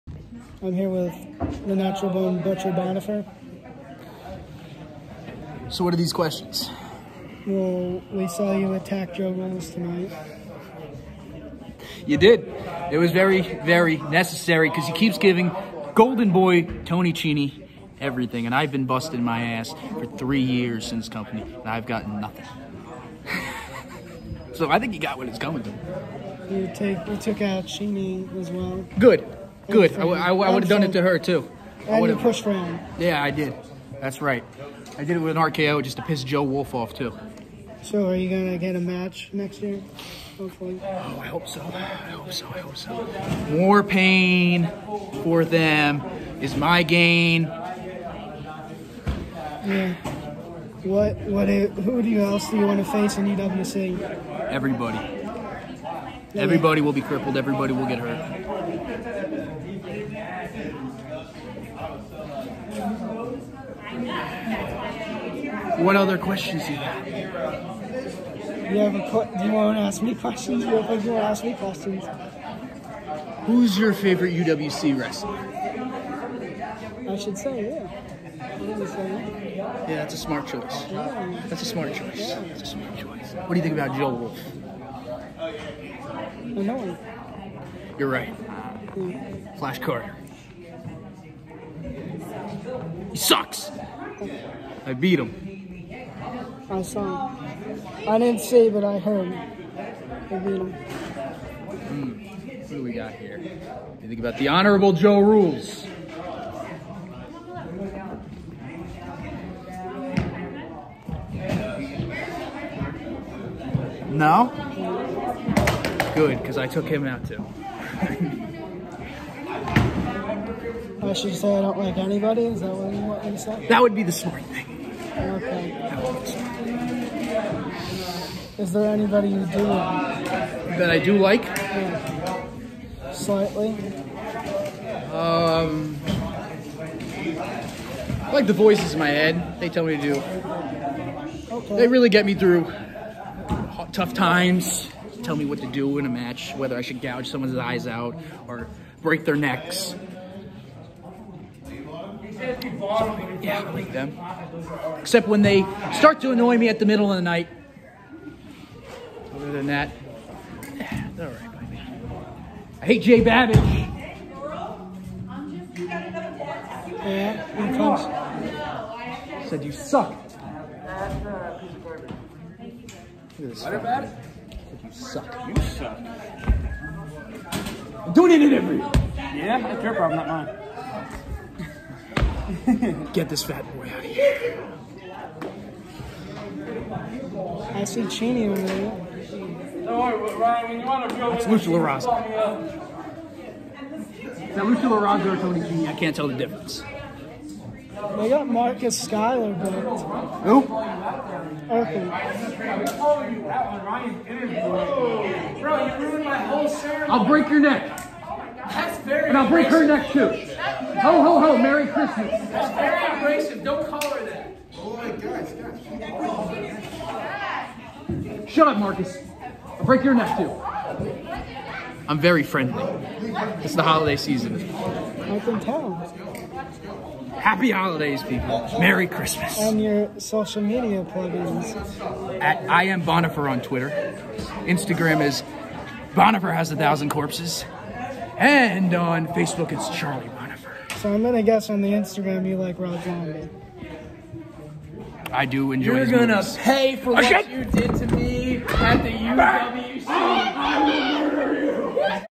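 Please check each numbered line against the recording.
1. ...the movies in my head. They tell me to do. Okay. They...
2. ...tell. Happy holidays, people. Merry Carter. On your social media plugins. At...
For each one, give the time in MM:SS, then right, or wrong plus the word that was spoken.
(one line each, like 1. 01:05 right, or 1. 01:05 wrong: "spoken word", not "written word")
1. 02:18 wrong: "voices", not "movies"
2. 03:45 wrong: "Christmas", not "Carter".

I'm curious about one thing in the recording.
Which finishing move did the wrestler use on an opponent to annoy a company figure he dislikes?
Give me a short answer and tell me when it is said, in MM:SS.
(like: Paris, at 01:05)
RKO, at 00:35.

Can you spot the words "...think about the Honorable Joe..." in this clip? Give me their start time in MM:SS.
01:44.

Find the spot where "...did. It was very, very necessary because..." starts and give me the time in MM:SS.
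00:12.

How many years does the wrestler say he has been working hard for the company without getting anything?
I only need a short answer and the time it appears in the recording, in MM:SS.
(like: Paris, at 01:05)
3, at 00:20.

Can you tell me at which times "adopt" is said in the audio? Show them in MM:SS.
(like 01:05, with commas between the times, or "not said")
not said.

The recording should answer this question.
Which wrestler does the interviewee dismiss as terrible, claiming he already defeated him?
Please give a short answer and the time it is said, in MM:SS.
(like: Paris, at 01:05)
Flash Carter, at 01:29.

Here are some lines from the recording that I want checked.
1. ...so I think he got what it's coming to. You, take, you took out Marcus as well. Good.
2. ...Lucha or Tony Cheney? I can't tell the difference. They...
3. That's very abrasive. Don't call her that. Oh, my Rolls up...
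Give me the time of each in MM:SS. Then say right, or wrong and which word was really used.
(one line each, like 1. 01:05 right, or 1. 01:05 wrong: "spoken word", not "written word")
1. 00:24 wrong: "Cheney", not "Marcus"
2. 03:14 right
3. 03:32 wrong: "Shut", not "Rolls".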